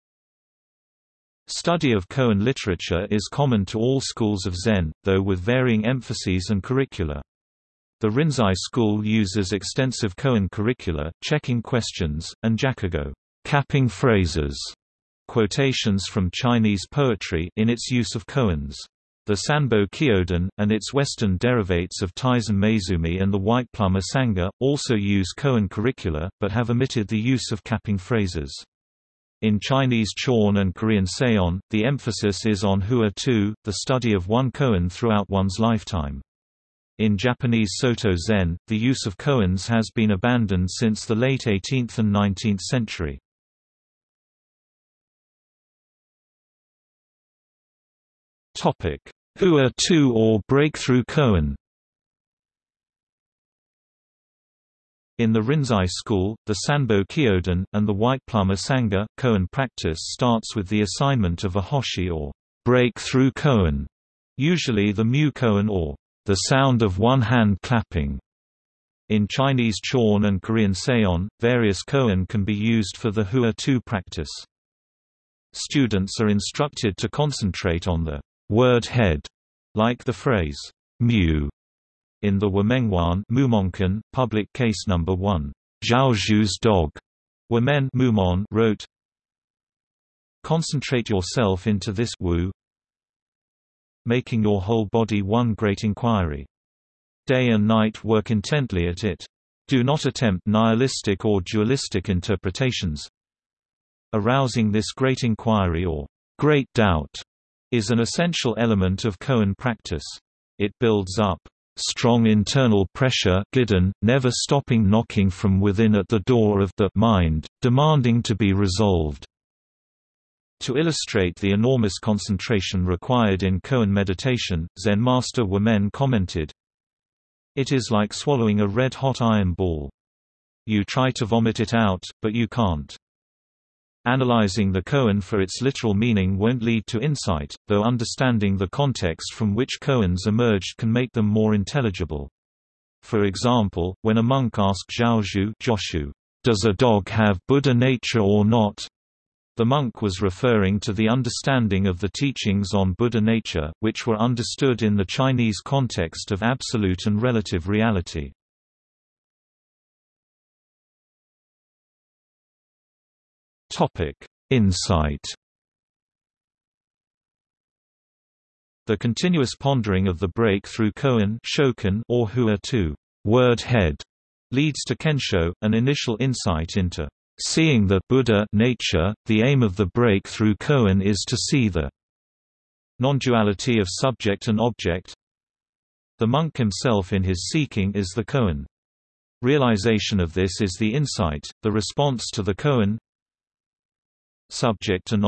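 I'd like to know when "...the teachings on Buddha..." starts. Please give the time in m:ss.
2:31.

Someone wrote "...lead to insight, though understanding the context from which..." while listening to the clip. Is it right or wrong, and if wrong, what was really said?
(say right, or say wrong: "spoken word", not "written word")
right.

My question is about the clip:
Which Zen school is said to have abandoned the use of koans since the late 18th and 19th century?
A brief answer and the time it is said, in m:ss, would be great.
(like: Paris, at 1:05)
Japanese Soto Zen, at 0:37.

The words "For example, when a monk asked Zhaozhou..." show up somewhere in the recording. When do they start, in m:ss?
2:23.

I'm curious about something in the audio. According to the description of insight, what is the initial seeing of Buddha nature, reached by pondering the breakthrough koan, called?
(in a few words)
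Kensho.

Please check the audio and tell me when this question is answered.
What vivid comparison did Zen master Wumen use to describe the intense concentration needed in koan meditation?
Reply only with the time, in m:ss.
2:08.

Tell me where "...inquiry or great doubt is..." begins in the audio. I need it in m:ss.
1:45.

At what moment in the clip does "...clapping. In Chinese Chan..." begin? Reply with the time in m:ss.
1:07.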